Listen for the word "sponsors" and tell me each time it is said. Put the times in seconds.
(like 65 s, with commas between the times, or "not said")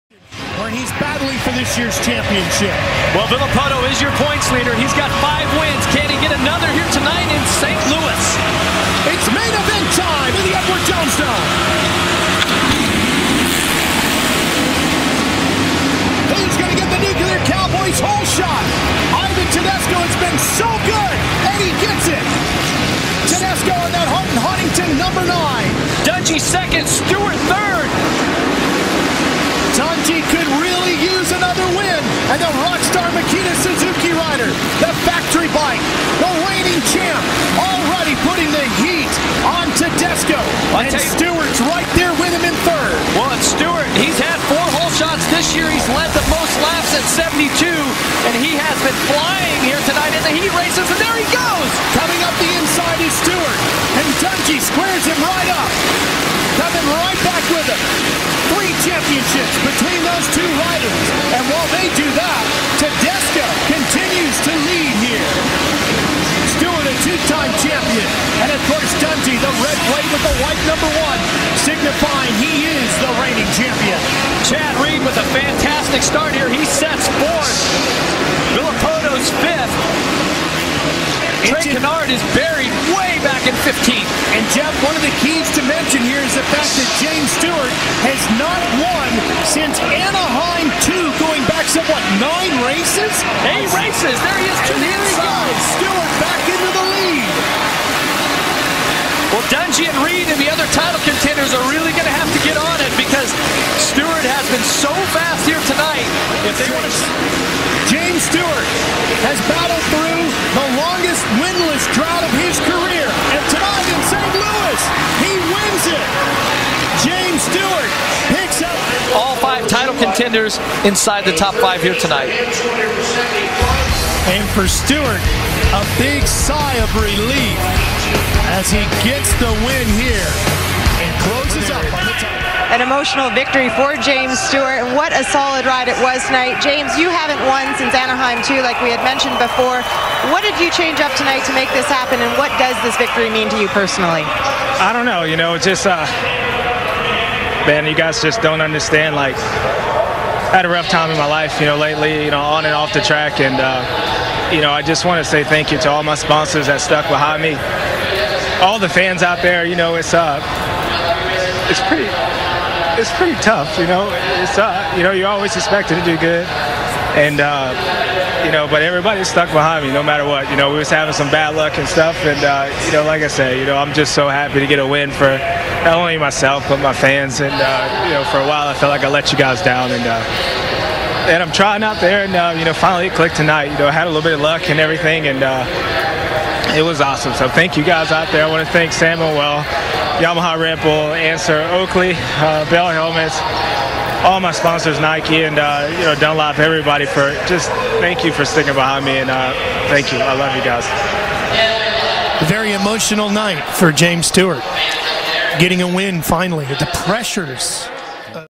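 156 s, 194 s.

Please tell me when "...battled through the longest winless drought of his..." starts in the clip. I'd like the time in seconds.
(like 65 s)
109 s.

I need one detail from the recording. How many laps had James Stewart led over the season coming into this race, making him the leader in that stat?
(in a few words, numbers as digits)
72.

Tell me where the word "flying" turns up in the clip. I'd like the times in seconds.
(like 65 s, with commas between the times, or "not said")
49 s.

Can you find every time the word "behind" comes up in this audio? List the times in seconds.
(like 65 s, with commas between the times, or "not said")
157 s, 169 s, 198 s.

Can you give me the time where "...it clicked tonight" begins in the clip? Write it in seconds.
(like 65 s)
183 s.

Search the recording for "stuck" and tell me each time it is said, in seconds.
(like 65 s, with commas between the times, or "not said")
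156 s, 169 s.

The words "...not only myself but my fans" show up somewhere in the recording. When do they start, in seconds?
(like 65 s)
175 s.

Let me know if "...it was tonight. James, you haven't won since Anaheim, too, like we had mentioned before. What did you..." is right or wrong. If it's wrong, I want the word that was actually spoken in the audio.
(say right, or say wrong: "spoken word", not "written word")
right.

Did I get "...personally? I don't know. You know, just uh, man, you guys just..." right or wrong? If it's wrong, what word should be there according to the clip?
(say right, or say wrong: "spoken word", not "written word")
right.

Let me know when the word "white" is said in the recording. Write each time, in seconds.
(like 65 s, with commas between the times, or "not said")
70 s.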